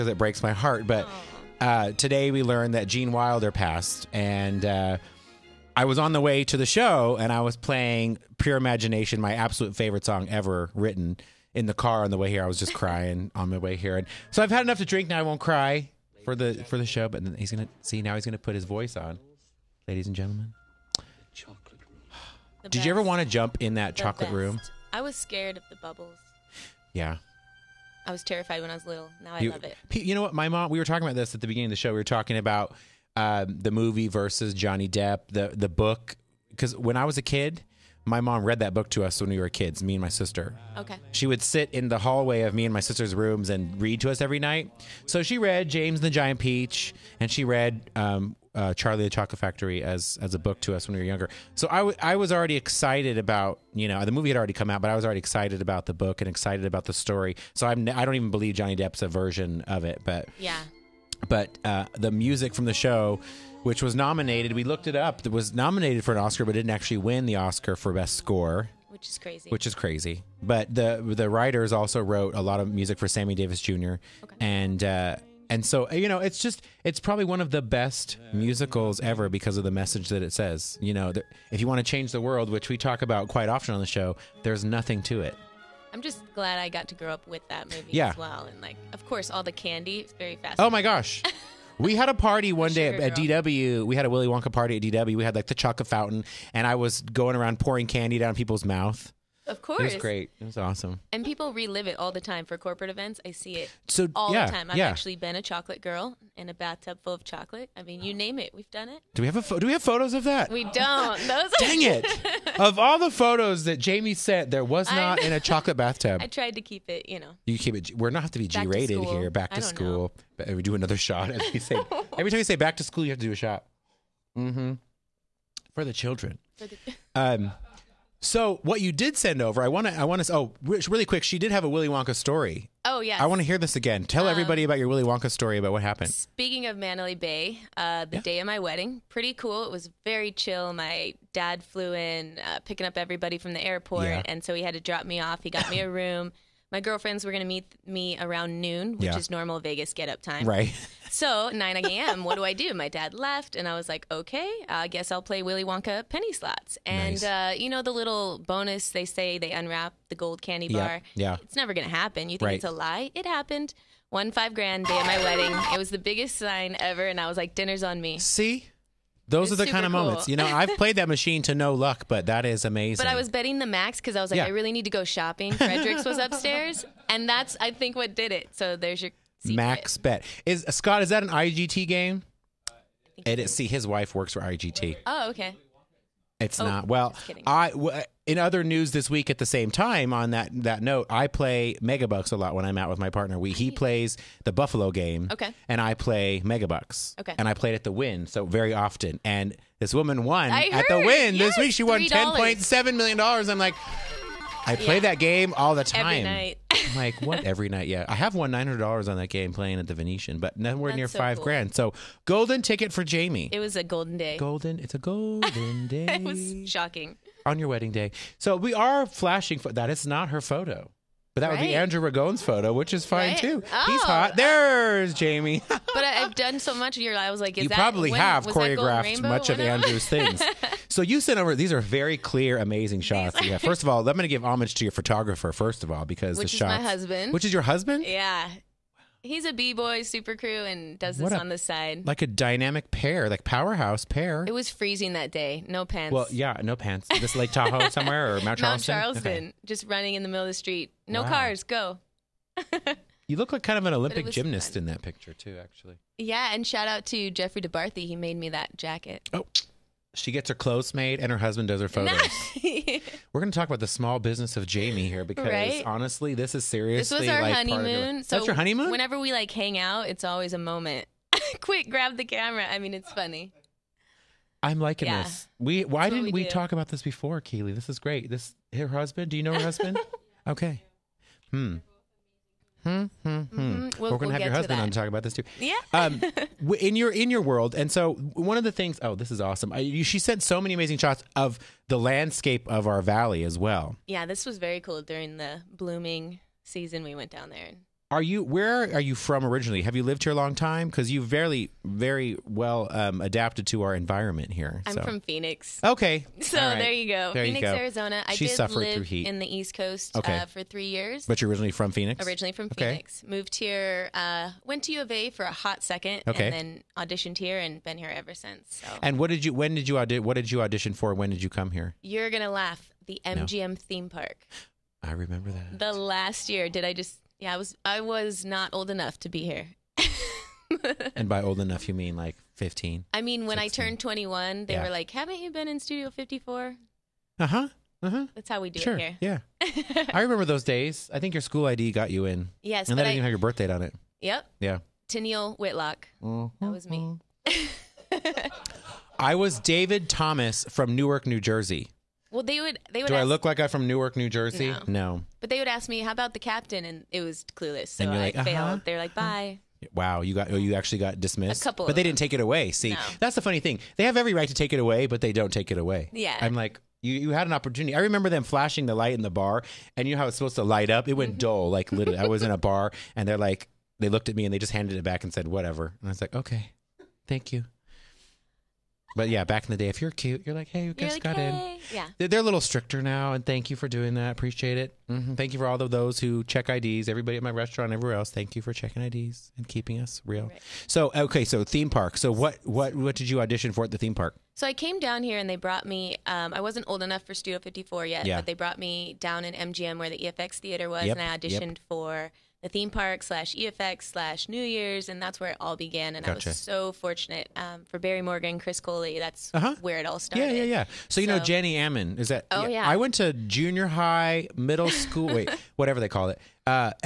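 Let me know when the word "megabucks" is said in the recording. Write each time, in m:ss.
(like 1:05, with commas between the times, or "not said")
3:11, 3:16.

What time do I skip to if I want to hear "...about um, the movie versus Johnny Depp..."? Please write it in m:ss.
0:32.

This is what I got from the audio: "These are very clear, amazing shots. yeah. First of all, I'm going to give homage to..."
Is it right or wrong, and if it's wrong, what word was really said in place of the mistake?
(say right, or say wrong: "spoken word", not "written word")
right.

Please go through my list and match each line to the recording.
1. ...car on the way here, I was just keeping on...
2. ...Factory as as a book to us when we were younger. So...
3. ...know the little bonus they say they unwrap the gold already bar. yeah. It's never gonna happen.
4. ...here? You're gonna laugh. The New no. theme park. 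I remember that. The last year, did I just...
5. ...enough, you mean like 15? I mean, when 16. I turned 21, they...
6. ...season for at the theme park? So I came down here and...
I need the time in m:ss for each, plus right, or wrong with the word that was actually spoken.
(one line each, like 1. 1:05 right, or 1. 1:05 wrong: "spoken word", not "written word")
1. 0:11 wrong: "crying", not "keeping"
2. 0:49 right
3. 2:37 wrong: "candy", not "already"
4. 5:21 wrong: "MGM", not "New"
5. 5:31 right
6. 6:33 wrong: "audition", not "season".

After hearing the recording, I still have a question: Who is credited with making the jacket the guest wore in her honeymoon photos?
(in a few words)
Jeffrey DeBarthy.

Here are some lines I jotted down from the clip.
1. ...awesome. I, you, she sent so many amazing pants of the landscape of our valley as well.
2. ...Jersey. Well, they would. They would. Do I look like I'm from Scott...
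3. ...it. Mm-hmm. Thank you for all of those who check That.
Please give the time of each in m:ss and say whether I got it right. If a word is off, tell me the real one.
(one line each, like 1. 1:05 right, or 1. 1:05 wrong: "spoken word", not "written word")
1. 4:49 wrong: "shots", not "pants"
2. 5:51 wrong: "Newark", not "Scott"
3. 6:24 wrong: "IDs", not "That".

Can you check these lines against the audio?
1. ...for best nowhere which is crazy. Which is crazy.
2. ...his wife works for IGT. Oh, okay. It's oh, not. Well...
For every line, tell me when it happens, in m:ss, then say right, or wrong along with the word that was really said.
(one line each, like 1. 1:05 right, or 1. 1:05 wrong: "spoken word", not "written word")
1. 1:07 wrong: "score", not "nowhere"
2. 3:03 right.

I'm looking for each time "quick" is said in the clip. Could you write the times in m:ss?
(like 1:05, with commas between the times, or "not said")
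2:11, 4:31.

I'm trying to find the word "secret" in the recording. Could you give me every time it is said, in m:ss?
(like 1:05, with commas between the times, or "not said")
2:59.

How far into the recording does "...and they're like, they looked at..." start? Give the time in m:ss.
6:13.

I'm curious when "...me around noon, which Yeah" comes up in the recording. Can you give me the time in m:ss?
2:27.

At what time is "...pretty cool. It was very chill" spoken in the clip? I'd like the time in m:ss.
2:19.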